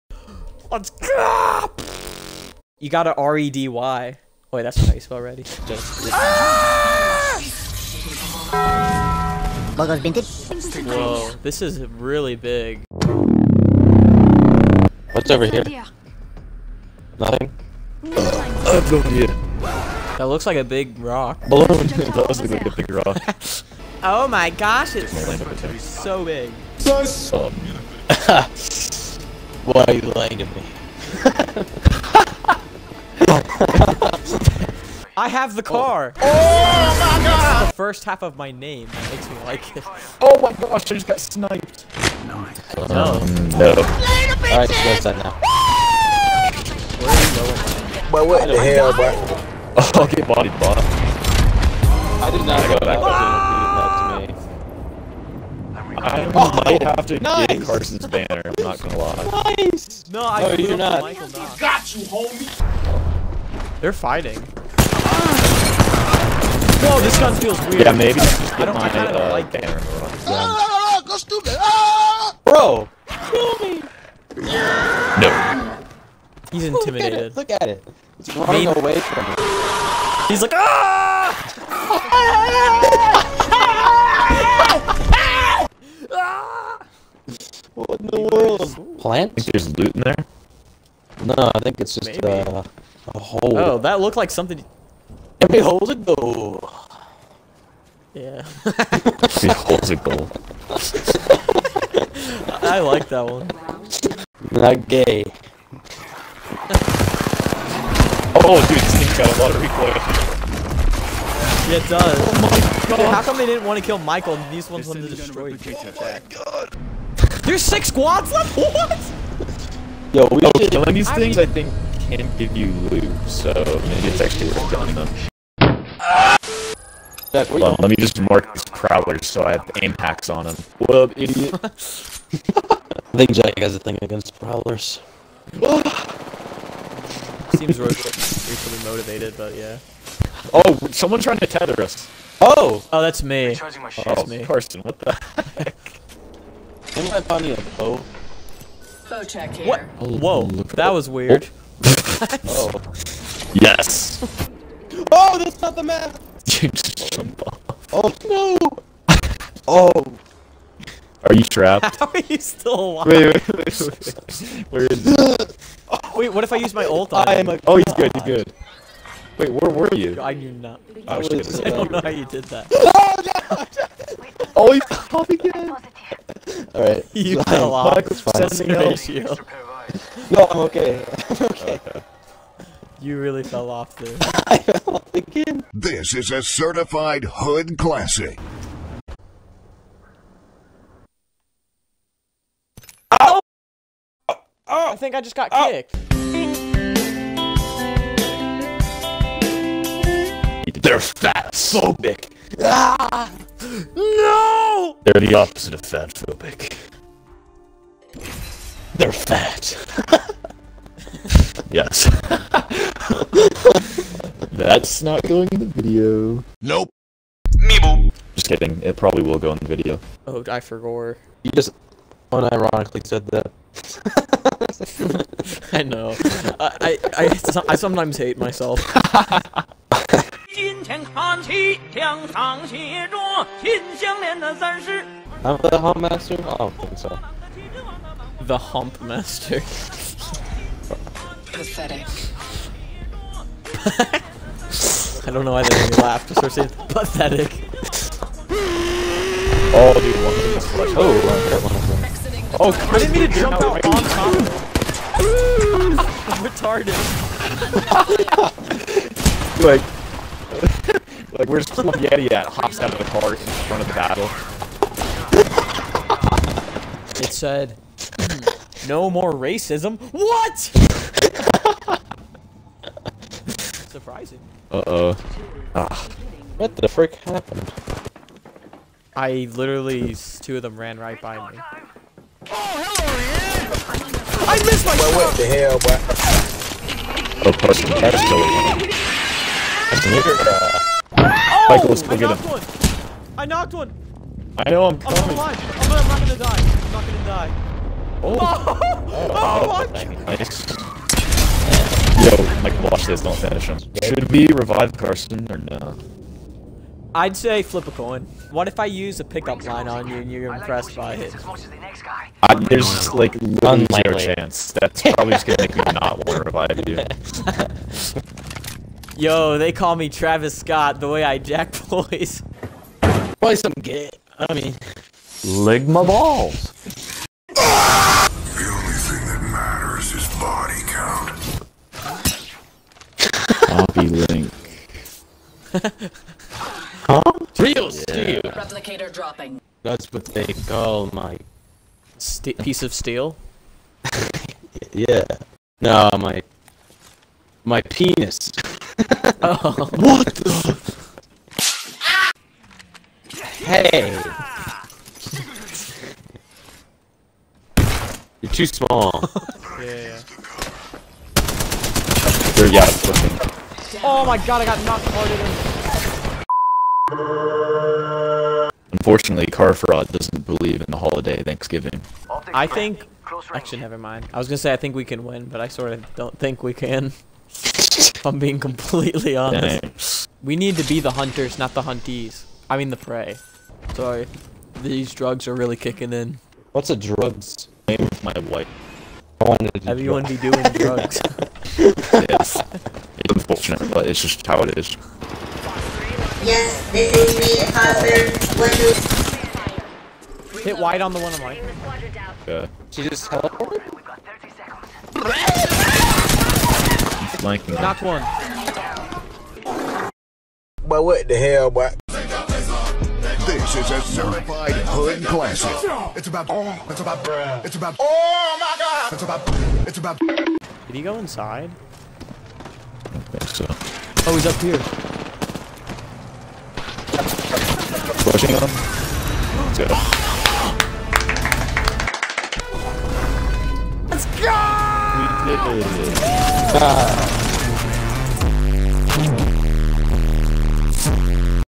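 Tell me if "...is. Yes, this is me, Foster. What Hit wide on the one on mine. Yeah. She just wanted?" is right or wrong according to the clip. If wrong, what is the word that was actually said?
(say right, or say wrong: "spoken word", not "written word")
wrong: "teleported", not "wanted".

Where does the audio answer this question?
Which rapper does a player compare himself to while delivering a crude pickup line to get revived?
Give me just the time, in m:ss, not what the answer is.
5:20.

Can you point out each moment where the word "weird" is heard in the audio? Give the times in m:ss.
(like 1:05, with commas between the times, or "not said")
1:07, 2:31.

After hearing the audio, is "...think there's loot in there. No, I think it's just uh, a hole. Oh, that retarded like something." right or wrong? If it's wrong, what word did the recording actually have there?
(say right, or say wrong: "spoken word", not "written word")
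wrong: "looked", not "retarded".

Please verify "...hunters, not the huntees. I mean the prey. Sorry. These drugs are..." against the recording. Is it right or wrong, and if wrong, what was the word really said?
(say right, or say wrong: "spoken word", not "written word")
right.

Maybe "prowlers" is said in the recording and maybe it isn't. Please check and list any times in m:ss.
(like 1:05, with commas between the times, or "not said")
2:08, 2:14.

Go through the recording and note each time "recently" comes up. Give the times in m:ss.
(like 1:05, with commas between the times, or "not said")
2:17.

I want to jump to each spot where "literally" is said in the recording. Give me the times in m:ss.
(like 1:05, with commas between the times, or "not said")
4:39, 5:13.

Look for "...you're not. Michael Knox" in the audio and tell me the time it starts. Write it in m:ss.
1:00.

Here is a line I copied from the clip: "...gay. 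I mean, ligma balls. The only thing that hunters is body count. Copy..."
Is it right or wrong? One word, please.
wrong.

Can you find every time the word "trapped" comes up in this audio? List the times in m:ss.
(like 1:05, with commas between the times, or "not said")
2:41.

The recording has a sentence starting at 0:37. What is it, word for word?
the first half of my name makes me like it.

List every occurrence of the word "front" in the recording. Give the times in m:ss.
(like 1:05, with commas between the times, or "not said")
4:23.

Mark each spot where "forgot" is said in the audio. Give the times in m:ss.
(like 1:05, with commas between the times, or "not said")
3:40.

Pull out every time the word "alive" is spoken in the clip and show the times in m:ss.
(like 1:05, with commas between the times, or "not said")
2:42, 4:55.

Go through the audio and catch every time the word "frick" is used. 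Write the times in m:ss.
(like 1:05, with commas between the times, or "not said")
4:36.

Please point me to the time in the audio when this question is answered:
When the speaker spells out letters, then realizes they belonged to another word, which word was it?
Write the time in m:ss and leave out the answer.
0:05.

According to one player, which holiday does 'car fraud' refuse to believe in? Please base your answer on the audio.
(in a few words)
Thanksgiving.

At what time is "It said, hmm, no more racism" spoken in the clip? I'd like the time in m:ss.
4:27.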